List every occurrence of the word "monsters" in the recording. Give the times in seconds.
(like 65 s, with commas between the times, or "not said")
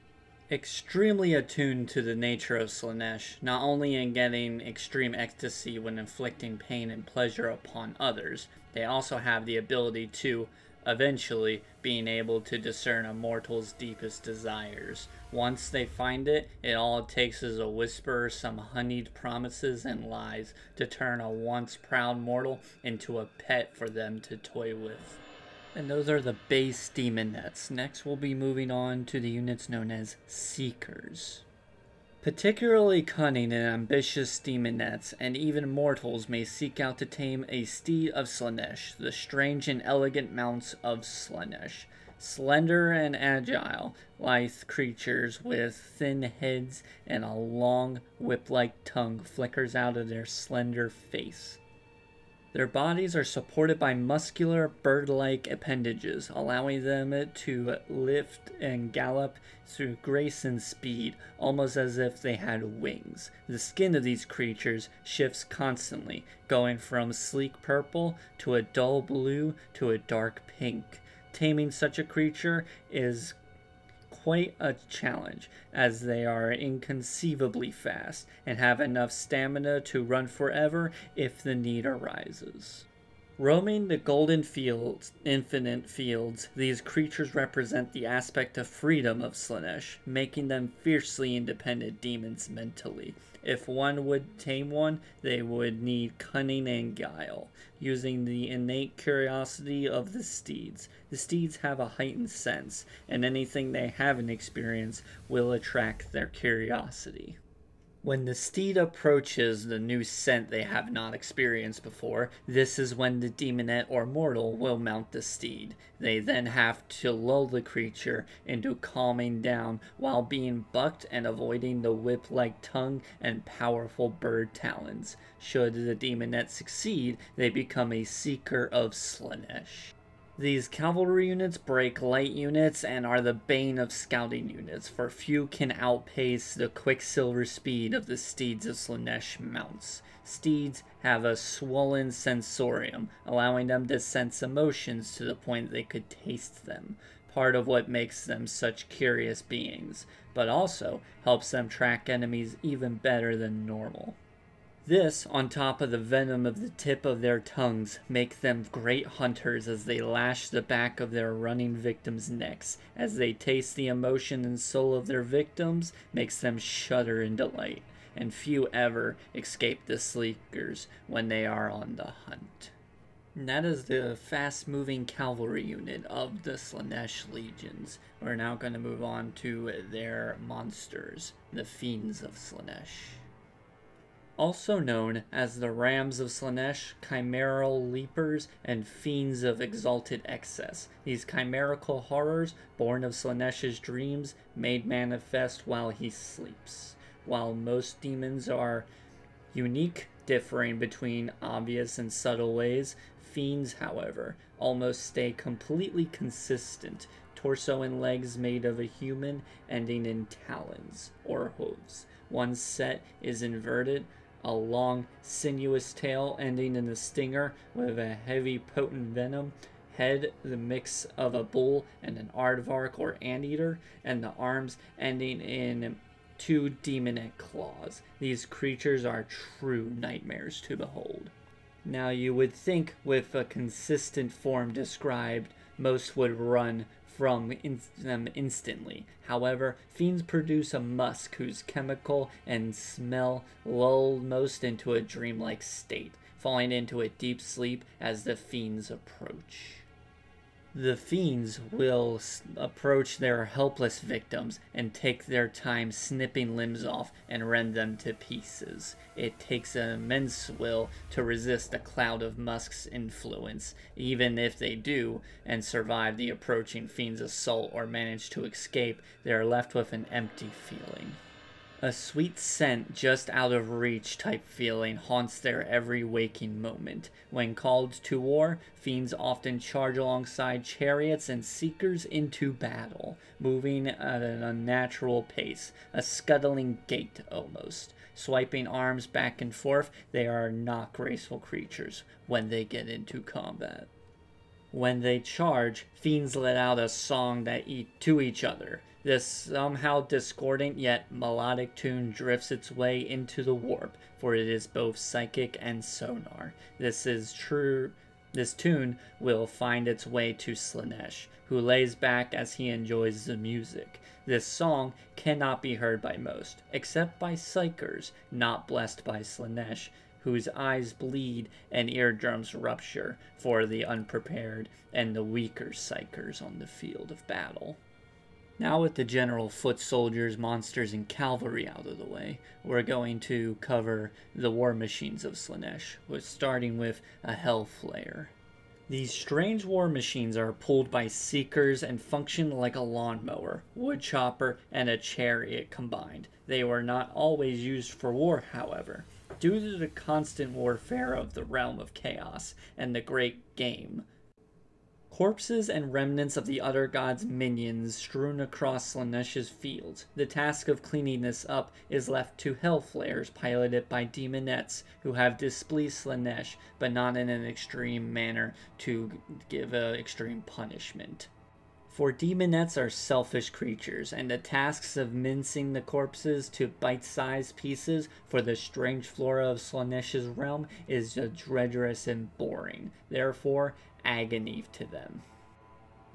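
180 s, 330 s.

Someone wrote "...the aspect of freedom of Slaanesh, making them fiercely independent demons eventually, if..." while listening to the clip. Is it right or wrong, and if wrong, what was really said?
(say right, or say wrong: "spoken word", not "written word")
wrong: "mentally", not "eventually".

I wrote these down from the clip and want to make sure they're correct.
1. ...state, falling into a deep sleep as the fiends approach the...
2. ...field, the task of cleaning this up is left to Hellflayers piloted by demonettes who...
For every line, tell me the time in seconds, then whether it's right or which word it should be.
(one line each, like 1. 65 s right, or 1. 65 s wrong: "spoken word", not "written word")
1. 245 s right
2. 359 s right.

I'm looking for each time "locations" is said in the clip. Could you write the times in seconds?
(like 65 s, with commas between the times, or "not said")
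not said.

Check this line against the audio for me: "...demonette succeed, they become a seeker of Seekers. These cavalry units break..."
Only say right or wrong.
wrong.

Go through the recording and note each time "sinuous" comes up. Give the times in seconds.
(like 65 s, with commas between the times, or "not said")
215 s.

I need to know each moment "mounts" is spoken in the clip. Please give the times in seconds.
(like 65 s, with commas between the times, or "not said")
40 s, 114 s, 139 s.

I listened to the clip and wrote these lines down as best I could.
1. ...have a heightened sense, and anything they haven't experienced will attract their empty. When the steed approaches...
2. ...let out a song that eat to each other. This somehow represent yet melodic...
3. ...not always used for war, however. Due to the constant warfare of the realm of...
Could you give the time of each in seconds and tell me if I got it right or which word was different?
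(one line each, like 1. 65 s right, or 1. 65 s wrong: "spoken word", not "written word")
1. 101 s wrong: "curiosity", not "empty"
2. 296 s wrong: "discordant", not "represent"
3. 346 s right.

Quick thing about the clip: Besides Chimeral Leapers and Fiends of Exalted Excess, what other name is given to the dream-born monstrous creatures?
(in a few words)
Rams of Slaanesh.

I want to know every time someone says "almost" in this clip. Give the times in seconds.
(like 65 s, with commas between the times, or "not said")
61 s, 204 s, 287 s.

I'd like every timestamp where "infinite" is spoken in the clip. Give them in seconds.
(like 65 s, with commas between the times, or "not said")
85 s.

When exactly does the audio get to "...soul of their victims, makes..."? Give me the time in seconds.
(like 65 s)
164 s.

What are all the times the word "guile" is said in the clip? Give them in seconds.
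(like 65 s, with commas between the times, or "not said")
96 s.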